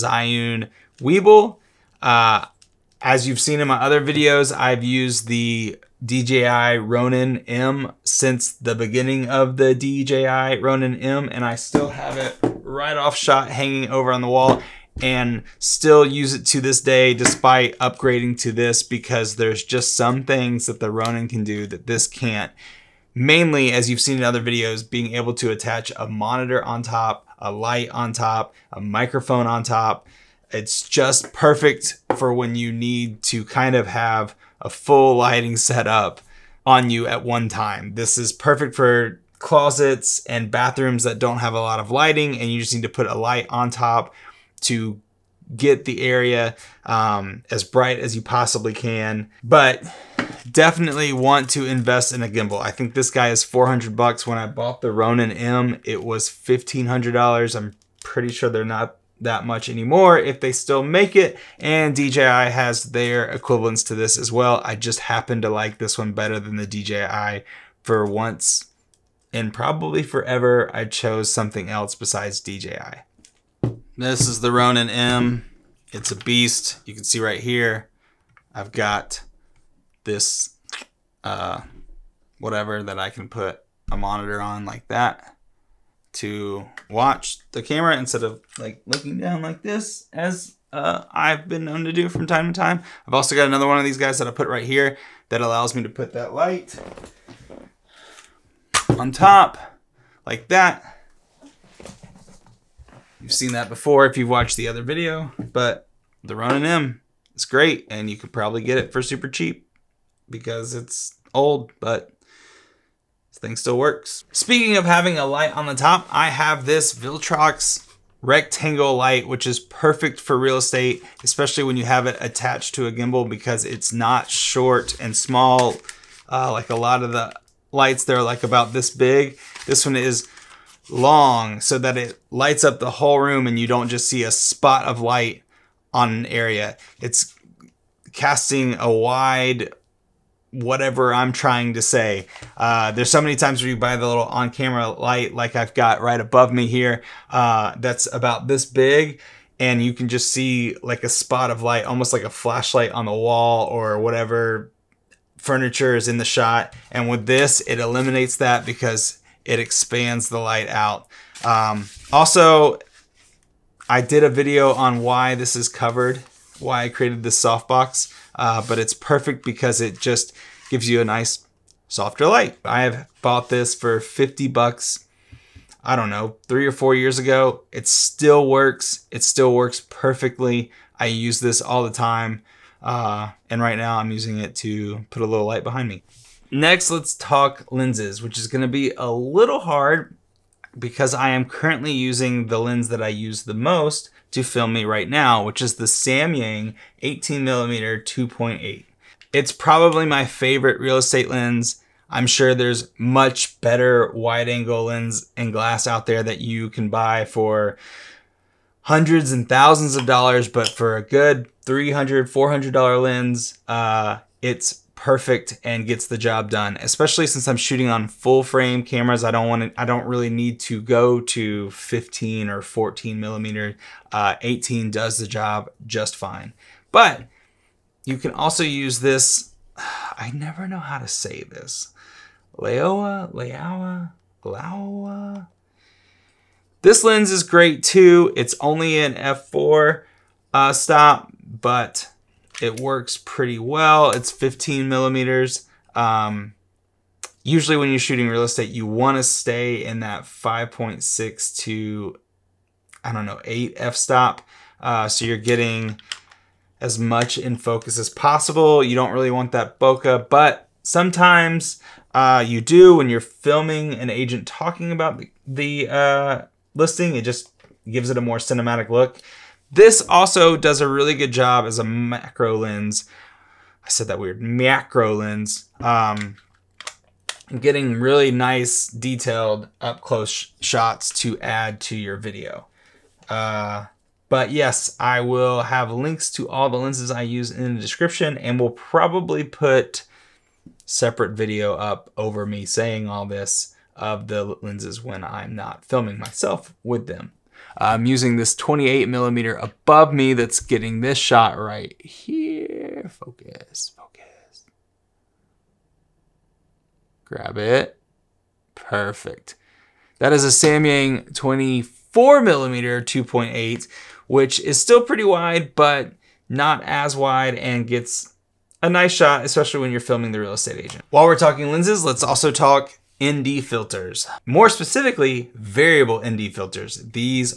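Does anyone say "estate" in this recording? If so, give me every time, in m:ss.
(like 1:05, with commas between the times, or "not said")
2:00, 3:20, 4:08, 5:20.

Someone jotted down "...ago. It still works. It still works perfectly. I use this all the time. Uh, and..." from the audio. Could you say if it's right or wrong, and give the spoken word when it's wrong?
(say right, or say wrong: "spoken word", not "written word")
right.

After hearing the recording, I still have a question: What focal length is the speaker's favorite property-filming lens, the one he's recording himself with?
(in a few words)
18mm.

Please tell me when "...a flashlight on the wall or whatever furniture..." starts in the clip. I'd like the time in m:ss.
2:32.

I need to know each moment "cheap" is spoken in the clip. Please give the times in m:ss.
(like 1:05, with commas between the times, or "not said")
1:49.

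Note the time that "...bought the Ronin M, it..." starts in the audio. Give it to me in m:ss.
0:54.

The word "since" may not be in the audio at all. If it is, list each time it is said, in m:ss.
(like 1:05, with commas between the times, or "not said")
0:08, 3:37.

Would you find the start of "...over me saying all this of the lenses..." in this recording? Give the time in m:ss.
4:52.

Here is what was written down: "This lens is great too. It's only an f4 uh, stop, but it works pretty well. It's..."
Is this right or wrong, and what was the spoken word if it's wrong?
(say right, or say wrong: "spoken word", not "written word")
right.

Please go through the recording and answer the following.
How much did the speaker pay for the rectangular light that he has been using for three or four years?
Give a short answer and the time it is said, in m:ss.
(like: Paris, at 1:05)
50 bucks, at 2:54.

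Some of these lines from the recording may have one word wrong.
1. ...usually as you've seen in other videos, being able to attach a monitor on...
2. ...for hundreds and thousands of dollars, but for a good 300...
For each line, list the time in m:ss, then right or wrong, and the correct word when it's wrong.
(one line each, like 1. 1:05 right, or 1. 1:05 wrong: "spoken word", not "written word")
1. 0:23 wrong: "mainly", not "usually"
2. 3:27 right.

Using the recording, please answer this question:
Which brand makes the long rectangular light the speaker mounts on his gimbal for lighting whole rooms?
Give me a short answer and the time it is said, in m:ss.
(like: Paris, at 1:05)
Viltrox, at 1:56.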